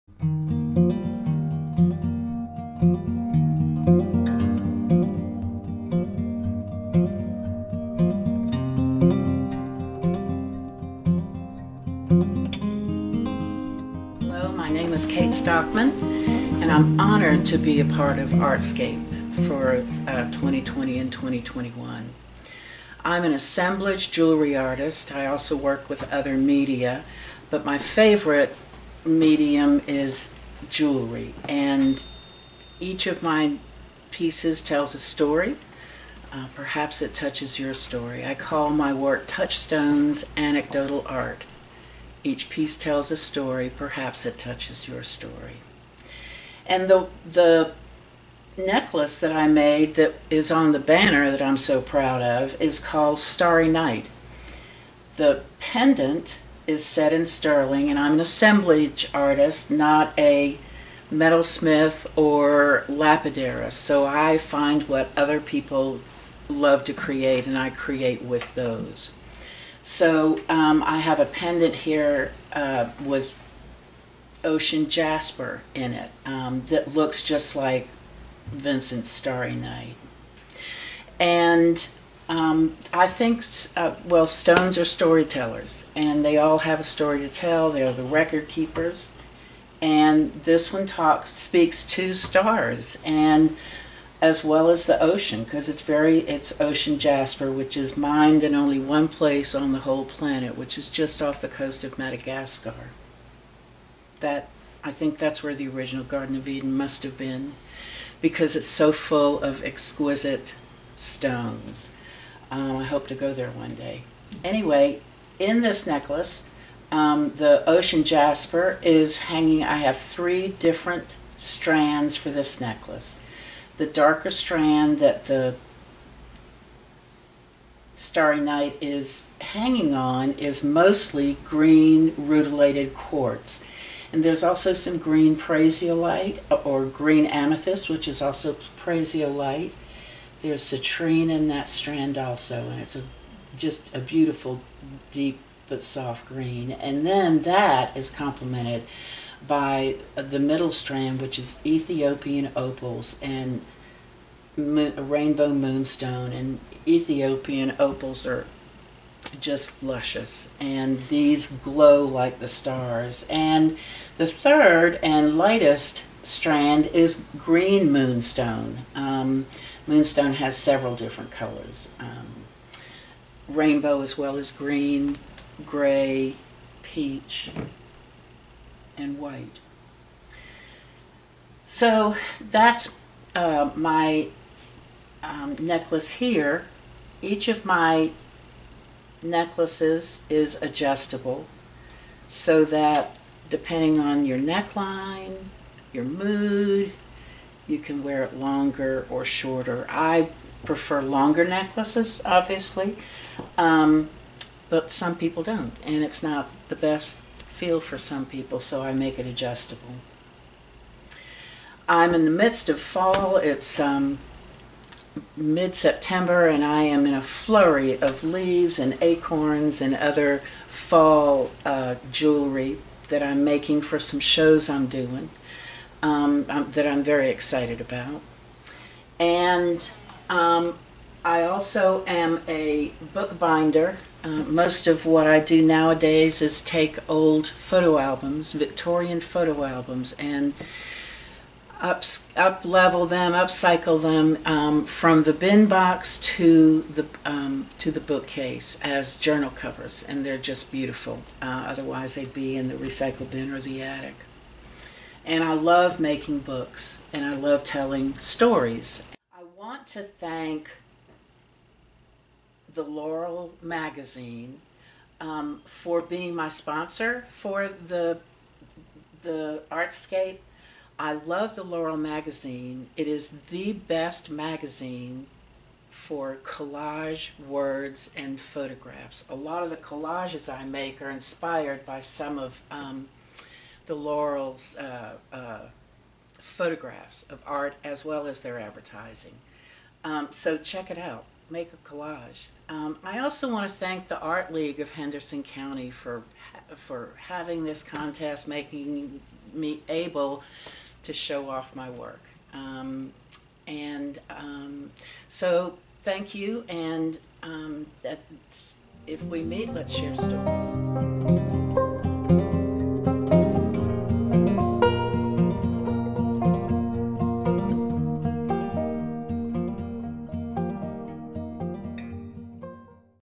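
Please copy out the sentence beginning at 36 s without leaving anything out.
Uh, perhaps it touches your story.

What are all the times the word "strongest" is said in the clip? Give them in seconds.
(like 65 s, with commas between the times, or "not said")
not said.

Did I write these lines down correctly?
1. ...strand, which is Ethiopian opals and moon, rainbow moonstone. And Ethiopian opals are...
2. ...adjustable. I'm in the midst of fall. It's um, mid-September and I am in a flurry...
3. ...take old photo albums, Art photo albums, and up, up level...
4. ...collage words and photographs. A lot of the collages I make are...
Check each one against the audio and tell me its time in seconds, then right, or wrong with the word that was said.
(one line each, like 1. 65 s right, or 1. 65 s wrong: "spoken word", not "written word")
1. 150 s right
2. 209 s right
3. 236 s wrong: "Victorian", not "Art"
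4. 276 s right.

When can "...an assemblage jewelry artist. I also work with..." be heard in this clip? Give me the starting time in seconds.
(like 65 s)
23 s.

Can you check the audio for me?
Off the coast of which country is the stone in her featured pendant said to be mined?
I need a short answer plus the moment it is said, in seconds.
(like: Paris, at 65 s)
Madagascar, at 101 s.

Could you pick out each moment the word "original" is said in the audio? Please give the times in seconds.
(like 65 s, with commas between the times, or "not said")
105 s.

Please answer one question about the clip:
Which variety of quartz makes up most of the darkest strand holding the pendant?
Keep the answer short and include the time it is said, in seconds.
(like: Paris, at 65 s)
green rutilated quartz, at 131 s.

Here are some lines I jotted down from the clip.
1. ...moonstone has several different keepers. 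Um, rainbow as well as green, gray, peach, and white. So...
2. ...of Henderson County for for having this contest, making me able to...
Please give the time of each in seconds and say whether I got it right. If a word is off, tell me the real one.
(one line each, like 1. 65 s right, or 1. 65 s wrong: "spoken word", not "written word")
1. 169 s wrong: "colors", not "keepers"
2. 294 s right.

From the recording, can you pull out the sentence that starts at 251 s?
Uh, otherwise, they'd be in the recycle bin or the attic.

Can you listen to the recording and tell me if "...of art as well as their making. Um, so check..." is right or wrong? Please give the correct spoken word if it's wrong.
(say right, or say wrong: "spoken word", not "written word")
wrong: "advertising", not "making".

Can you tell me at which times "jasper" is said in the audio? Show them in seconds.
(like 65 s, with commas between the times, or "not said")
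74 s, 96 s, 118 s.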